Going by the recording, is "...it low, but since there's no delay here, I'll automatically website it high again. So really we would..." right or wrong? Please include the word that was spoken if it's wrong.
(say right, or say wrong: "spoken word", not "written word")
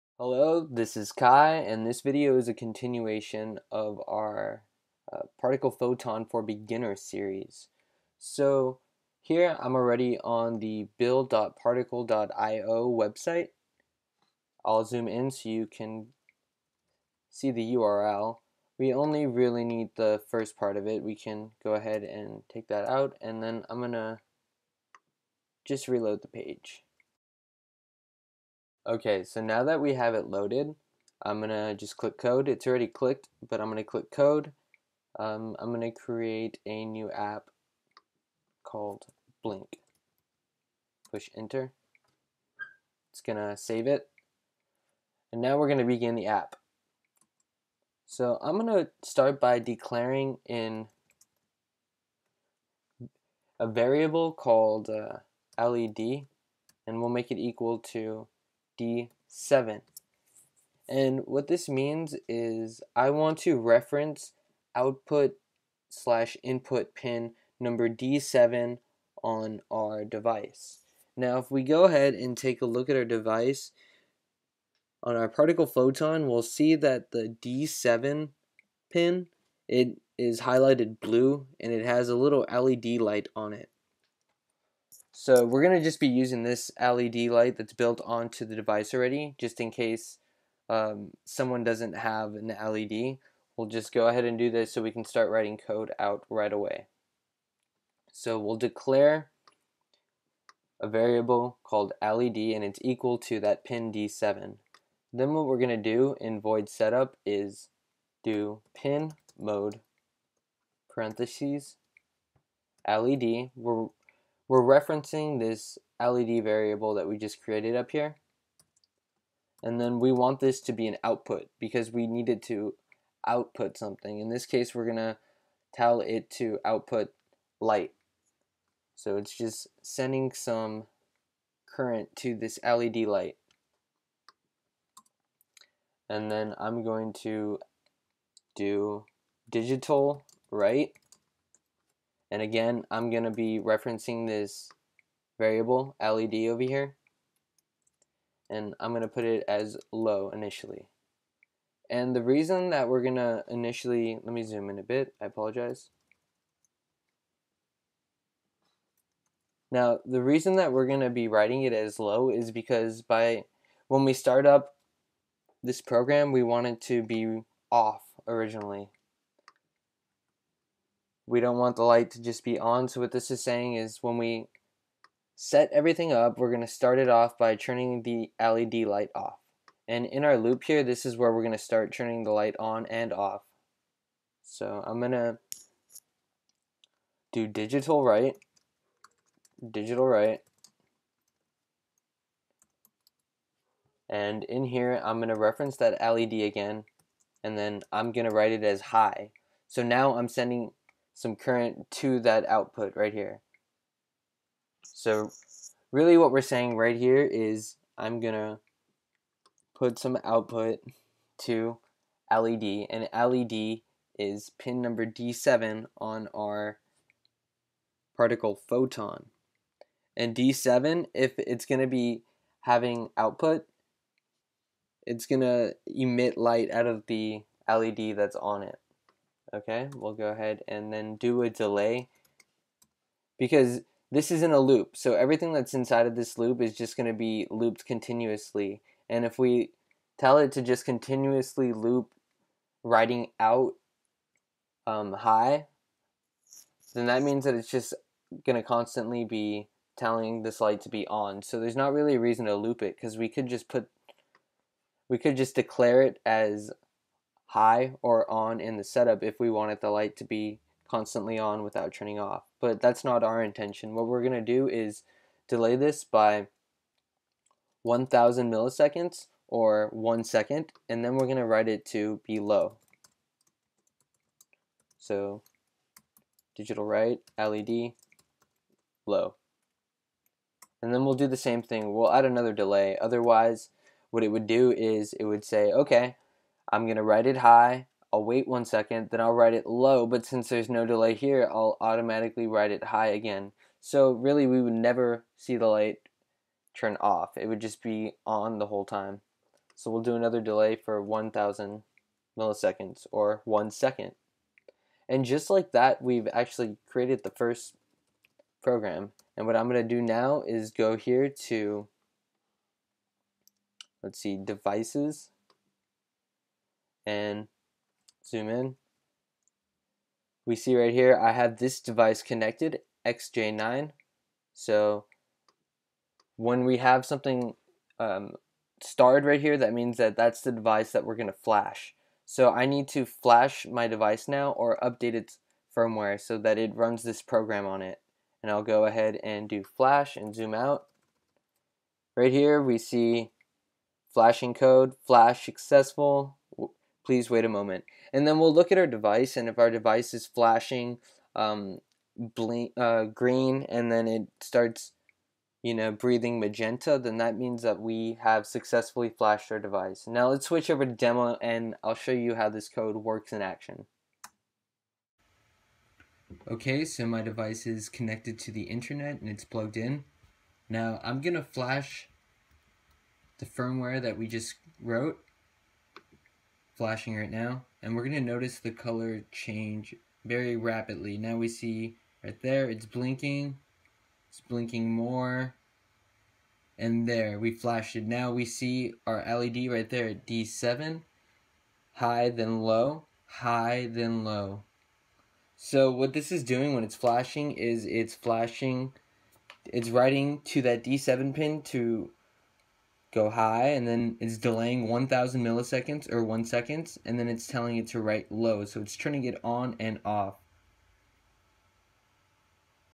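wrong: "write", not "website".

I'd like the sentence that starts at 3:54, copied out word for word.
So everything that's inside of this loop is just going to be looped continuously.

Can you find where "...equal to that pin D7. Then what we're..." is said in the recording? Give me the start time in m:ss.
1:42.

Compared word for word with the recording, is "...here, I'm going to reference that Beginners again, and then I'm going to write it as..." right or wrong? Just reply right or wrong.
wrong.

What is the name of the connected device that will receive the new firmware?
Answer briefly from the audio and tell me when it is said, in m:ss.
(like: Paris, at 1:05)
XJ9, at 5:23.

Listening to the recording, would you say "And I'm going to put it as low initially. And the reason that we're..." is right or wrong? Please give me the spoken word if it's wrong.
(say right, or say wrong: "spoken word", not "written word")
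right.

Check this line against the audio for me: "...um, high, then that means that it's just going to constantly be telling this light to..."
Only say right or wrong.
right.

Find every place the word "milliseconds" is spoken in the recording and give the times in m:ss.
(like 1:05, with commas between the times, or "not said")
4:28, 5:02, 6:45.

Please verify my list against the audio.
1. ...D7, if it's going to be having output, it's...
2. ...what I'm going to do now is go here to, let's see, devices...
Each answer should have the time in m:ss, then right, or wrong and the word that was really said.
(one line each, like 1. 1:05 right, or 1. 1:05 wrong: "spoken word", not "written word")
1. 3:40 right
2. 5:09 right.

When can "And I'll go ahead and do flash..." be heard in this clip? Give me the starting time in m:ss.
5:38.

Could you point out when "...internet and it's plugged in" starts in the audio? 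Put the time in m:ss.
6:08.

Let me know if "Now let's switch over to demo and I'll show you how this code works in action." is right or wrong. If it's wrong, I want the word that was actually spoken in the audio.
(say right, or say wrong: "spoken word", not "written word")
right.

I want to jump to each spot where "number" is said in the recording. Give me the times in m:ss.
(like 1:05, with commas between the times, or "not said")
1:07, 3:34.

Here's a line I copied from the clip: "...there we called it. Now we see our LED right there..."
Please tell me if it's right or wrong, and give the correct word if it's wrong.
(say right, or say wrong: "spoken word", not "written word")
wrong: "flashed", not "called".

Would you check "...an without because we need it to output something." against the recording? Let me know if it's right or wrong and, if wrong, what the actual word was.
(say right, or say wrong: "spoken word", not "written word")
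wrong: "output", not "without".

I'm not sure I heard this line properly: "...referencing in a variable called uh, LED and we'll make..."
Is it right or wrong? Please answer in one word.
wrong.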